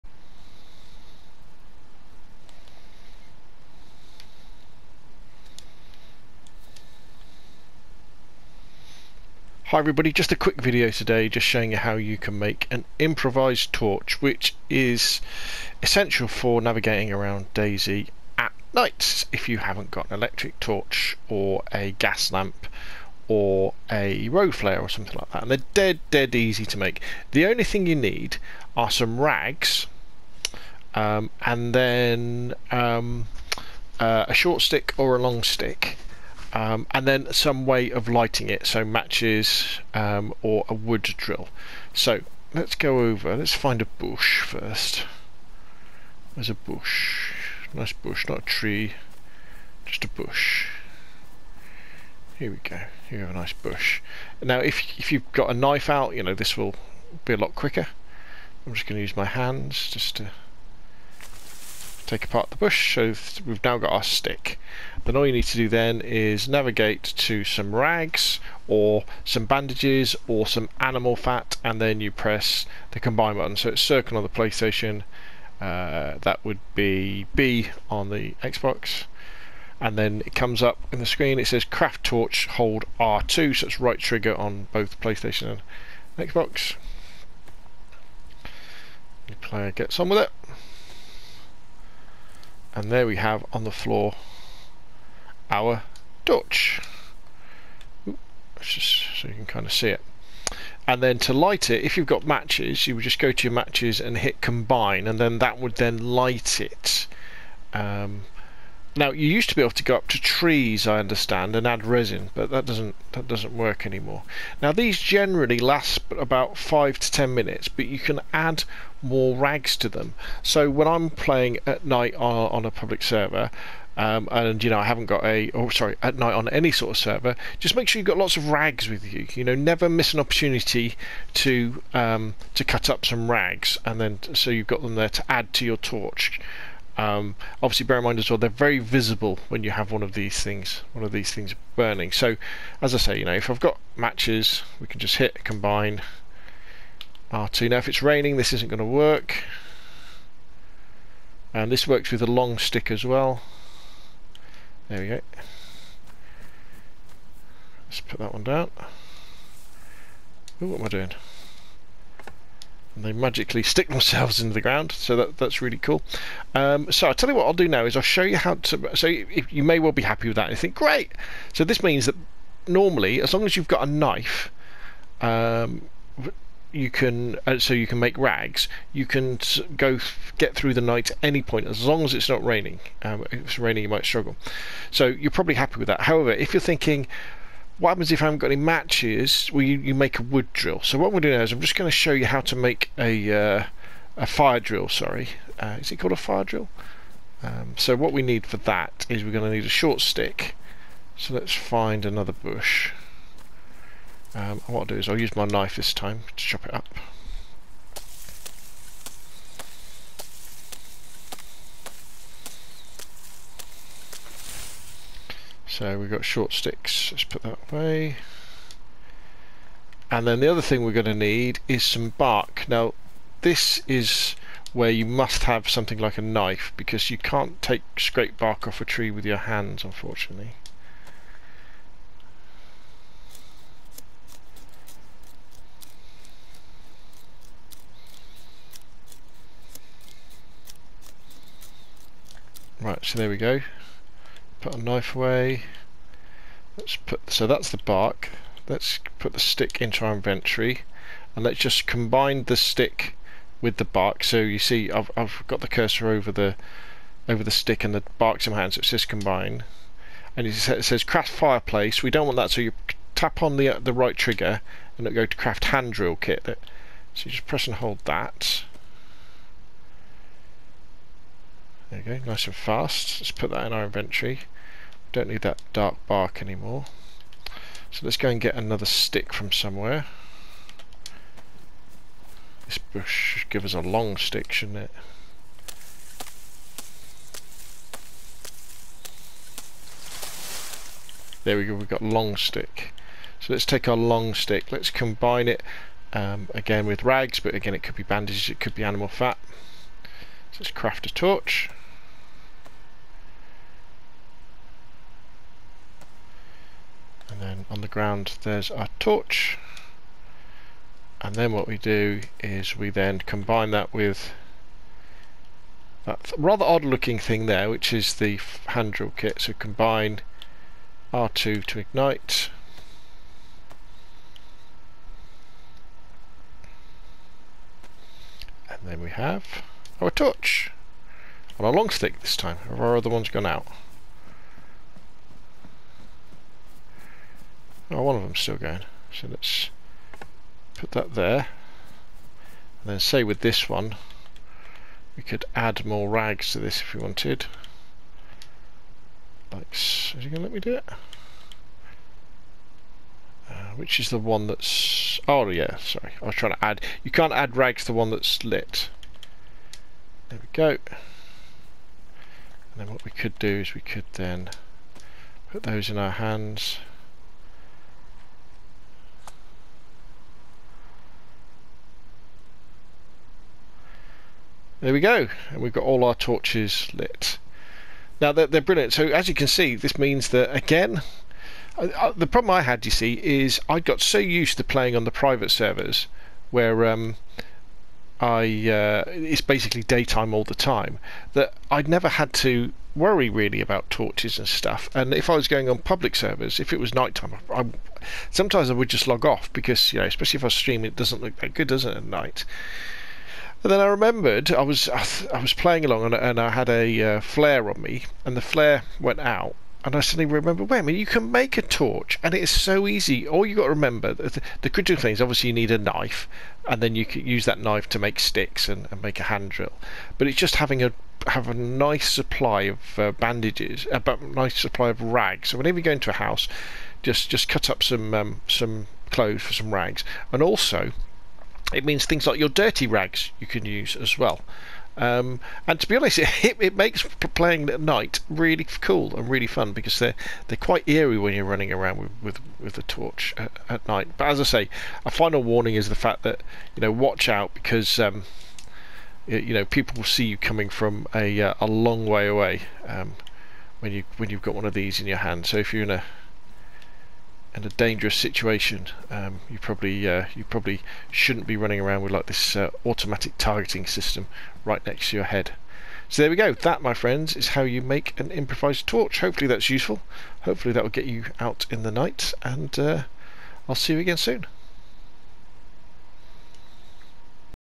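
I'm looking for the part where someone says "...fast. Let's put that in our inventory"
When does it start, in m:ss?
4:32.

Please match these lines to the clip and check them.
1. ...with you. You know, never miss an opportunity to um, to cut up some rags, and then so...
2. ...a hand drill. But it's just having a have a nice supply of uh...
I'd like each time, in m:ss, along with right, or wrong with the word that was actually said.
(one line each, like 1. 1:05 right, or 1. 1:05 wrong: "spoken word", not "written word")
1. 2:08 right
2. 6:59 right.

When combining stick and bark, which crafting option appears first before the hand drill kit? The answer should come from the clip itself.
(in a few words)
craft fireplace.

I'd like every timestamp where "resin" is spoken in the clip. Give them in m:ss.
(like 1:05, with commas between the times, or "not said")
1:51.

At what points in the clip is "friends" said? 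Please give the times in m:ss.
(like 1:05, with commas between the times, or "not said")
7:46.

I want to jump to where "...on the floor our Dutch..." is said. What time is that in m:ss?
1:33.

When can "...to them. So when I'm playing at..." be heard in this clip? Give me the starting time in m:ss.
1:59.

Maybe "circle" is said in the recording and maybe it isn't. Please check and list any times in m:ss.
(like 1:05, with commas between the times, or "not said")
1:13.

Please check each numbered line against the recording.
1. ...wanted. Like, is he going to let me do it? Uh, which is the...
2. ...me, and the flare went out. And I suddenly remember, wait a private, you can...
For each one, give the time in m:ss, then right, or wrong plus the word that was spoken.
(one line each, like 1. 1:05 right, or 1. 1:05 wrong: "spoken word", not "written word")
1. 5:47 right
2. 6:47 wrong: "minute", not "private".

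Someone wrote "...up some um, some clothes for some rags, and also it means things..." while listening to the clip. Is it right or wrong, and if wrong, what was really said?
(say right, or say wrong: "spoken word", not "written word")
right.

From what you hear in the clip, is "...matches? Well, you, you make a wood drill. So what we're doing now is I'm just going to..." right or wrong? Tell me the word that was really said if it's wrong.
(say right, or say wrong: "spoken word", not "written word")
right.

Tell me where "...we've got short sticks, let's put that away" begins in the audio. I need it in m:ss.
3:35.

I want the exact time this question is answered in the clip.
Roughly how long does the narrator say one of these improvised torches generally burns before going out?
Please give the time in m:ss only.
1:56.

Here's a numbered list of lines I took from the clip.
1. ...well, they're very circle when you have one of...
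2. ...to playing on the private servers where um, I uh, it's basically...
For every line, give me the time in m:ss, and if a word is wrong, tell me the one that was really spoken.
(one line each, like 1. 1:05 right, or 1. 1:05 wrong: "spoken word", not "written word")
1. 2:18 wrong: "visible", not "circle"
2. 6:24 right.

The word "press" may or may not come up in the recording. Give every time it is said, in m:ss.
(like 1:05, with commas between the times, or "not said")
1:12, 4:27.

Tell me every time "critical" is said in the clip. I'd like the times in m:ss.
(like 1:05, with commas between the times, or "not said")
6:54.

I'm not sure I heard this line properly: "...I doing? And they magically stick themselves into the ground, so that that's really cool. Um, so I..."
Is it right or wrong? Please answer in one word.
right.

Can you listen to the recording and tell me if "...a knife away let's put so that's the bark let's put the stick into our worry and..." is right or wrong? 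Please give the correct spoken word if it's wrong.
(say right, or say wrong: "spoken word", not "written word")
wrong: "inventory", not "worry".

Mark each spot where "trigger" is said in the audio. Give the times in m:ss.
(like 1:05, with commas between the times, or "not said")
1:23, 4:24.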